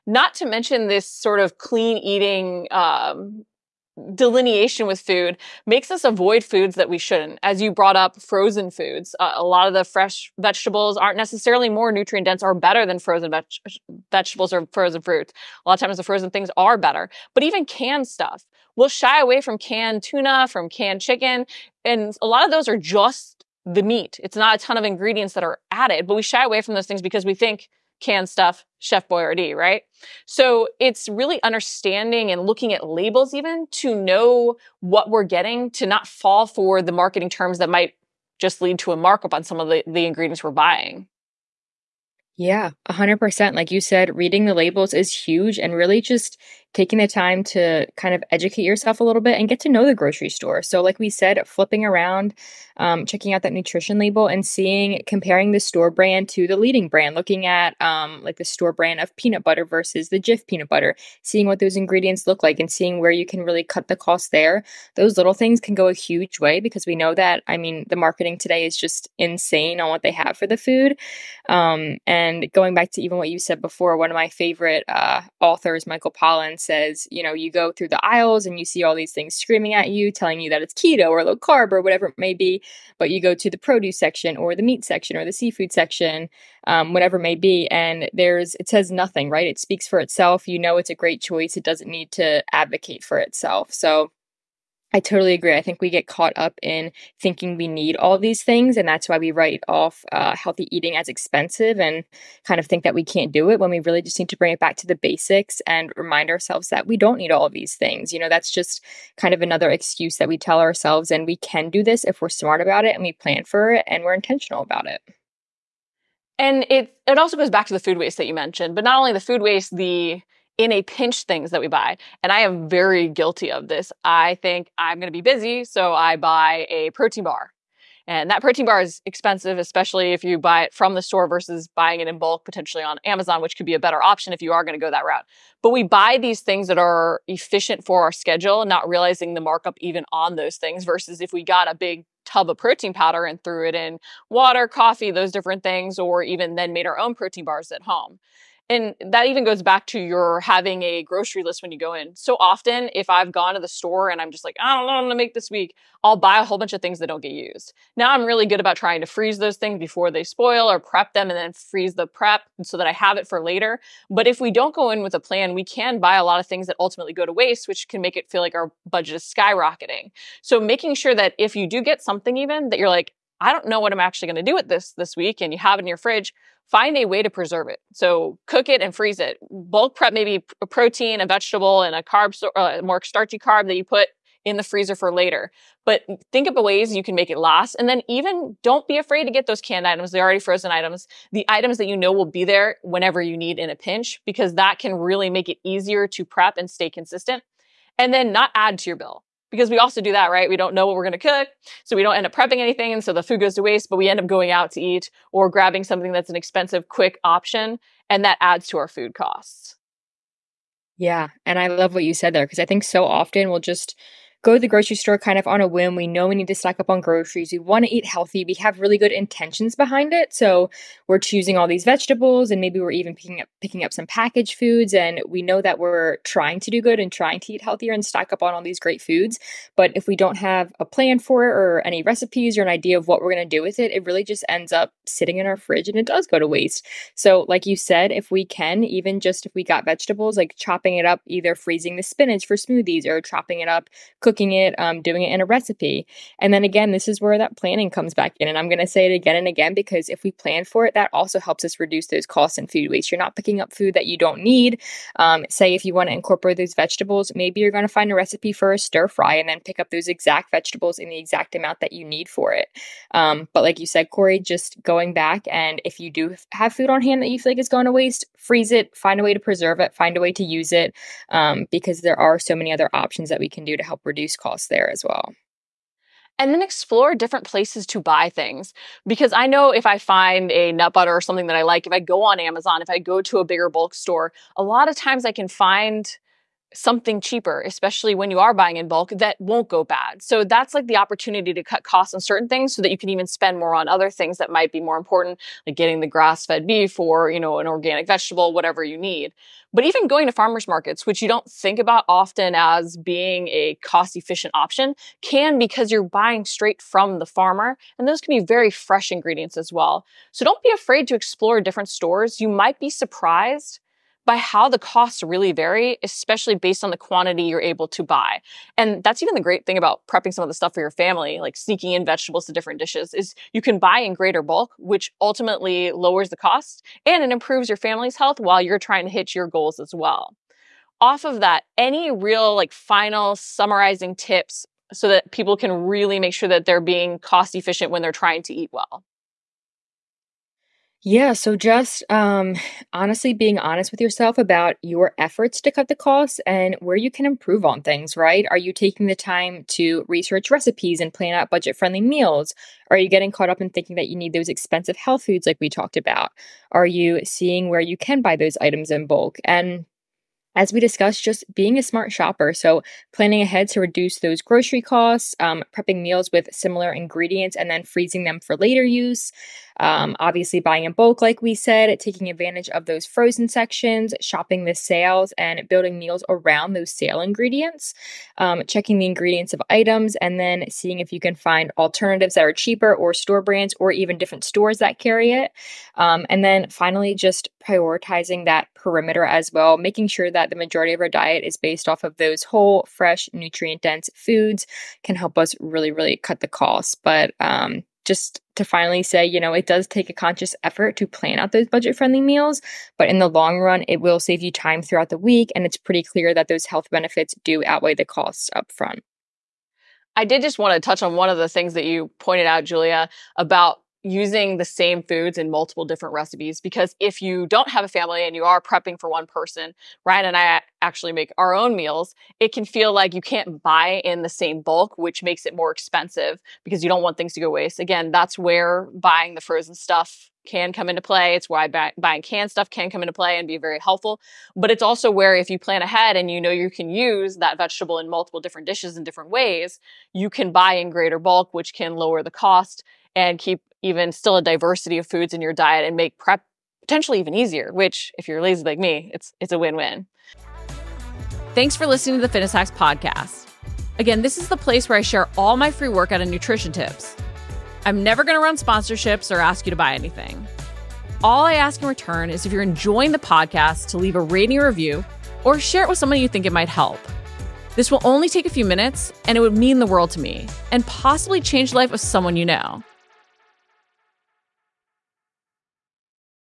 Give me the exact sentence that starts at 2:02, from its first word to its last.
And I am very guilty of this.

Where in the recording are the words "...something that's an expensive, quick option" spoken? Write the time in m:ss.
3:25.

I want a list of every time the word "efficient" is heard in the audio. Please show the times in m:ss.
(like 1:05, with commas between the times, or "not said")
2:17, 5:03, 5:37.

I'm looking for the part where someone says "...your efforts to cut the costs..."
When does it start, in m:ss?
5:44.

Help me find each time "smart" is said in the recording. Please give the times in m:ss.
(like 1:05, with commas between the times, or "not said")
1:52, 6:01.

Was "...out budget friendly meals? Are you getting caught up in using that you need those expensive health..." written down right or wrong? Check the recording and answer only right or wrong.
wrong.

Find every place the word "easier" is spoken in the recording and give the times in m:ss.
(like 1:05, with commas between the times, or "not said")
3:15, 7:27.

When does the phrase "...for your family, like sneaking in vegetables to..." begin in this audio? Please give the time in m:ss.
5:20.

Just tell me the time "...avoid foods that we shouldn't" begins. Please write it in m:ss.
0:06.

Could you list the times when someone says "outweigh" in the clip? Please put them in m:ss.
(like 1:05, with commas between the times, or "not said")
6:47.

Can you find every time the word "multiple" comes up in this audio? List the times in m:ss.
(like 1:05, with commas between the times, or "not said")
6:55, 7:18.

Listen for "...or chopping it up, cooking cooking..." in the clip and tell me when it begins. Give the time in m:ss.
4:03.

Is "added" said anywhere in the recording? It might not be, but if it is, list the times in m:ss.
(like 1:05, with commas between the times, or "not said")
0:25.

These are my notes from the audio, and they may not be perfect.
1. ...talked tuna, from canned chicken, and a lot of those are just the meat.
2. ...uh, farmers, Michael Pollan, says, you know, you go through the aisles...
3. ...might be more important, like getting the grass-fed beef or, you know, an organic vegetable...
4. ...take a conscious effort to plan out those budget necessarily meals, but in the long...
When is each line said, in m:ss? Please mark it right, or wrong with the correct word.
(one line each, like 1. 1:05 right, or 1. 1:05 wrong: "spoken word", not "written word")
1. 0:19 wrong: "canned", not "talked"
2. 1:14 wrong: "authors", not "farmers"
3. 4:54 right
4. 6:39 wrong: "friendly", not "necessarily".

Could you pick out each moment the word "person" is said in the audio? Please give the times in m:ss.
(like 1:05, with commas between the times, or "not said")
6:59.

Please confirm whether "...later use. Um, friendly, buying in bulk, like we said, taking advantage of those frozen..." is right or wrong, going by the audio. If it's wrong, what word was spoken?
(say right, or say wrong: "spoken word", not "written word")
wrong: "obviously", not "friendly".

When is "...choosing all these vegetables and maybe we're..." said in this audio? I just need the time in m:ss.
3:41.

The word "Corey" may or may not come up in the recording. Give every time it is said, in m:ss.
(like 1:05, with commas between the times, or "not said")
4:24.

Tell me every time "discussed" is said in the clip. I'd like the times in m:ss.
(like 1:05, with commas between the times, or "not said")
6:00.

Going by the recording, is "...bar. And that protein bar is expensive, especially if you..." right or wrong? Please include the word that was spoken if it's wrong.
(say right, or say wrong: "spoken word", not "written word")
right.